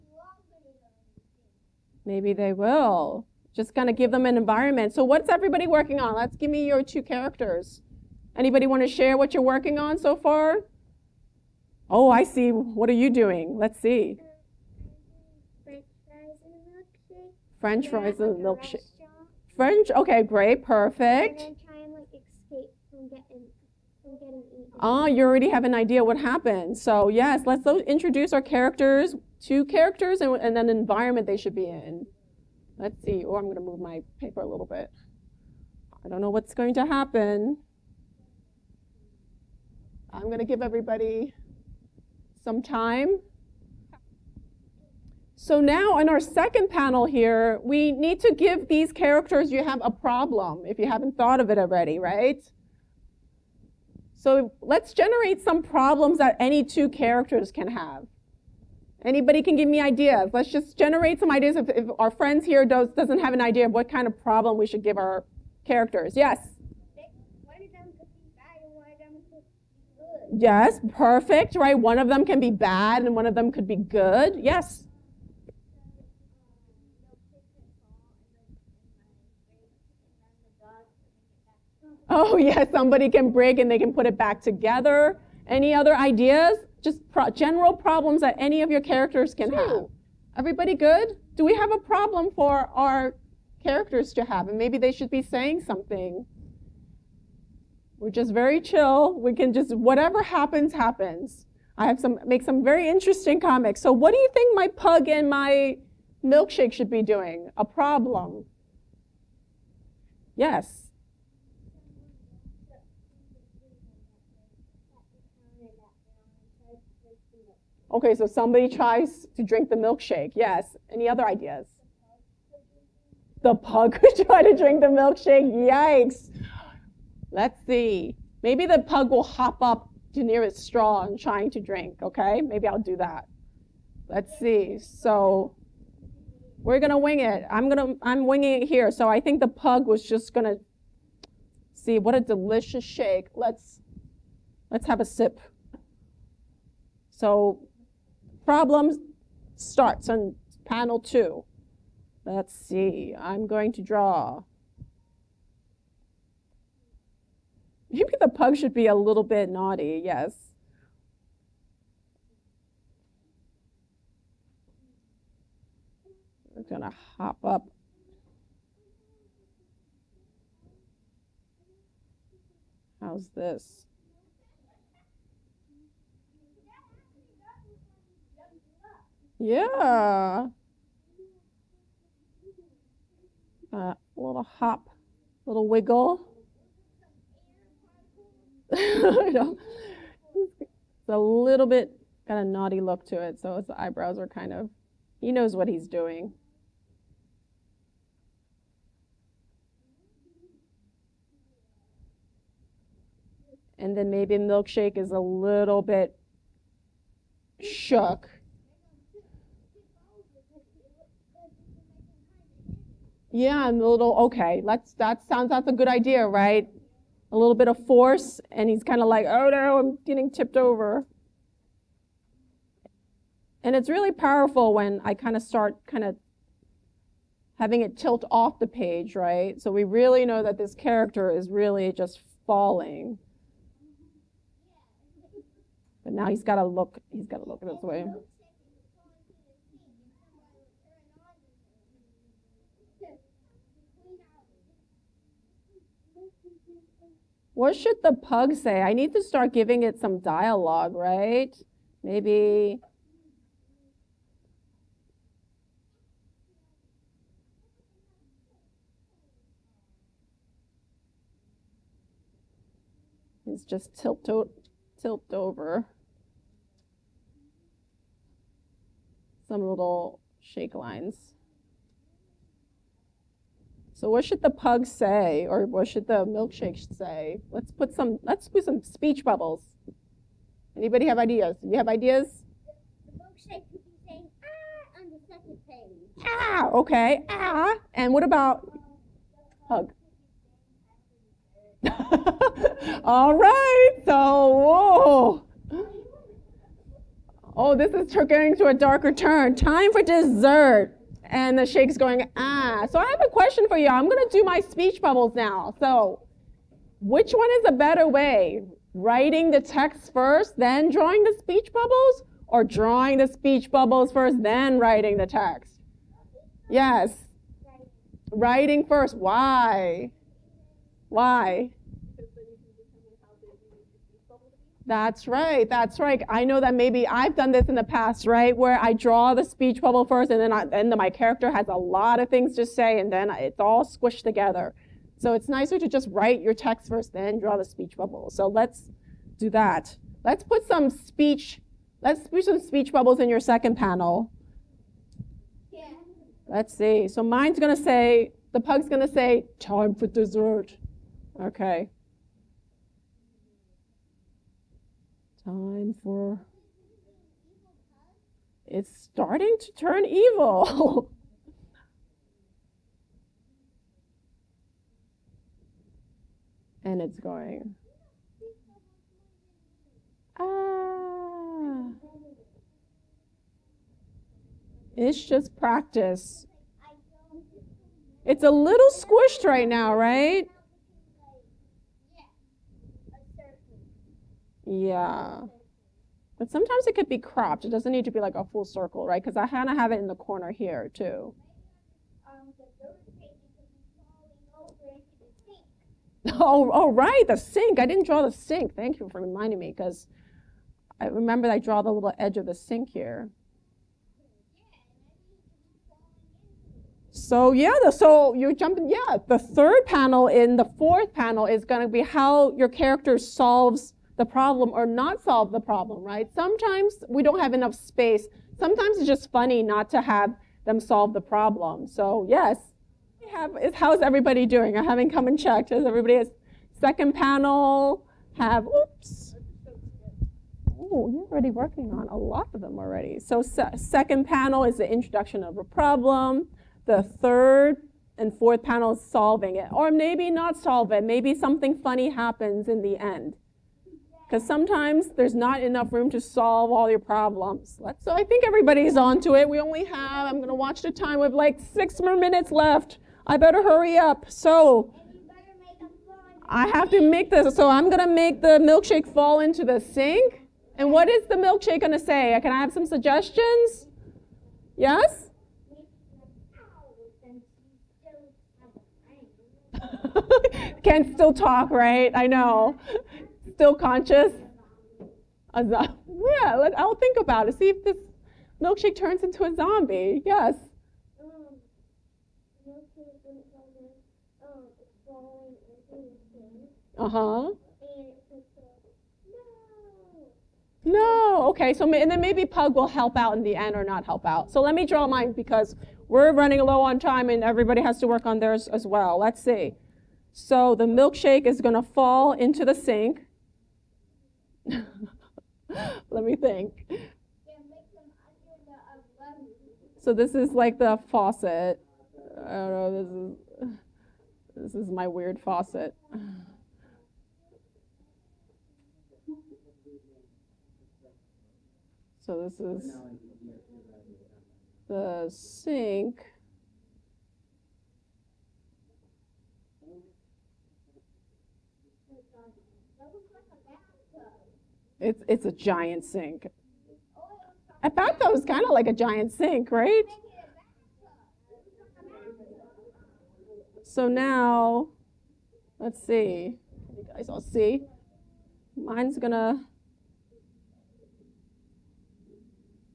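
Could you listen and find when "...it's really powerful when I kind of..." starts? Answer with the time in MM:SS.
03:43.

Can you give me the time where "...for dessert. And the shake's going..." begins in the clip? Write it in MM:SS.
04:59.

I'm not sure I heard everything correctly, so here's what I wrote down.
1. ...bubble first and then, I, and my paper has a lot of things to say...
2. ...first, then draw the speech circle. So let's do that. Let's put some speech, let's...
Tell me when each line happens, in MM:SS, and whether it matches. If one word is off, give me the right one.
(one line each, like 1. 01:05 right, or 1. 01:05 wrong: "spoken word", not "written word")
1. 05:29 wrong: "character", not "paper"
2. 05:36 wrong: "bubble", not "circle".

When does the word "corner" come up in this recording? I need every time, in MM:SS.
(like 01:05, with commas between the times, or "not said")
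06:30.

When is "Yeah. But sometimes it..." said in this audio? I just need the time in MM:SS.
06:24.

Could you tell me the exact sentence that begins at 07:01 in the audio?
So yes, have, how's everybody doing?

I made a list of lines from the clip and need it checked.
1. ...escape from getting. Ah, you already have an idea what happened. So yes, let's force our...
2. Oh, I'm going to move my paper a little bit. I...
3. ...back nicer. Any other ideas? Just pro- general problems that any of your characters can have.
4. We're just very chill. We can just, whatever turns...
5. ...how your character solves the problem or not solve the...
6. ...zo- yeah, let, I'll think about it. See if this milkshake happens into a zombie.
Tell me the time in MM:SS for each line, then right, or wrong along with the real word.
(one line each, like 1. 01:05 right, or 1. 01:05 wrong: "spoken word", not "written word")
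1. 00:22 wrong: "introduce", not "force"
2. 00:33 right
3. 01:24 wrong: "together", not "nicer"
4. 01:38 wrong: "happens", not "turns"
5. 06:52 right
6. 07:55 wrong: "turns", not "happens".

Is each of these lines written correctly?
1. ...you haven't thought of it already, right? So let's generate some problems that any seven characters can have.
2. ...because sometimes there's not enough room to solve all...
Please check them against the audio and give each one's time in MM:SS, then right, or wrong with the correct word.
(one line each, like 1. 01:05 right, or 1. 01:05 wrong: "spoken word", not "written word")
1. 00:50 wrong: "two", not "seven"
2. 07:24 right.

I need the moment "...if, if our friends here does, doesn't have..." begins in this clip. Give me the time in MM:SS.
01:01.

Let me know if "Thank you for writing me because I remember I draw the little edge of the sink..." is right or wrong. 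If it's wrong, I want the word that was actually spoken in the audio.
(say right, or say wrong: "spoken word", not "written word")
wrong: "reminding", not "writing".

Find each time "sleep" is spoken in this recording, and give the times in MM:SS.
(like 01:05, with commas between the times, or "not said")
not said.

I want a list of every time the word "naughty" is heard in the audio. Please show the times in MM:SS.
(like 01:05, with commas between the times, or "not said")
02:39, 03:12.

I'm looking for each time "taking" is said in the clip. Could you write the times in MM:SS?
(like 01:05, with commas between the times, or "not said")
not said.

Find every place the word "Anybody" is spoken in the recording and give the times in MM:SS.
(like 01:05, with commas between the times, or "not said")
00:08, 00:59, 04:40.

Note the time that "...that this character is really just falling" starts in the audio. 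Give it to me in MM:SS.
03:50.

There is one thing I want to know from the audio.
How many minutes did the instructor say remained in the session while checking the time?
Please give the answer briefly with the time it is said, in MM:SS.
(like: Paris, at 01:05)
6, at 07:31.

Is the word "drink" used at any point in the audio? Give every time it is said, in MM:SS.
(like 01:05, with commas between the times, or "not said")
01:59, 02:04, 02:11.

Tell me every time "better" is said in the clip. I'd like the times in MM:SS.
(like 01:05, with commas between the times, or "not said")
05:07, 07:33.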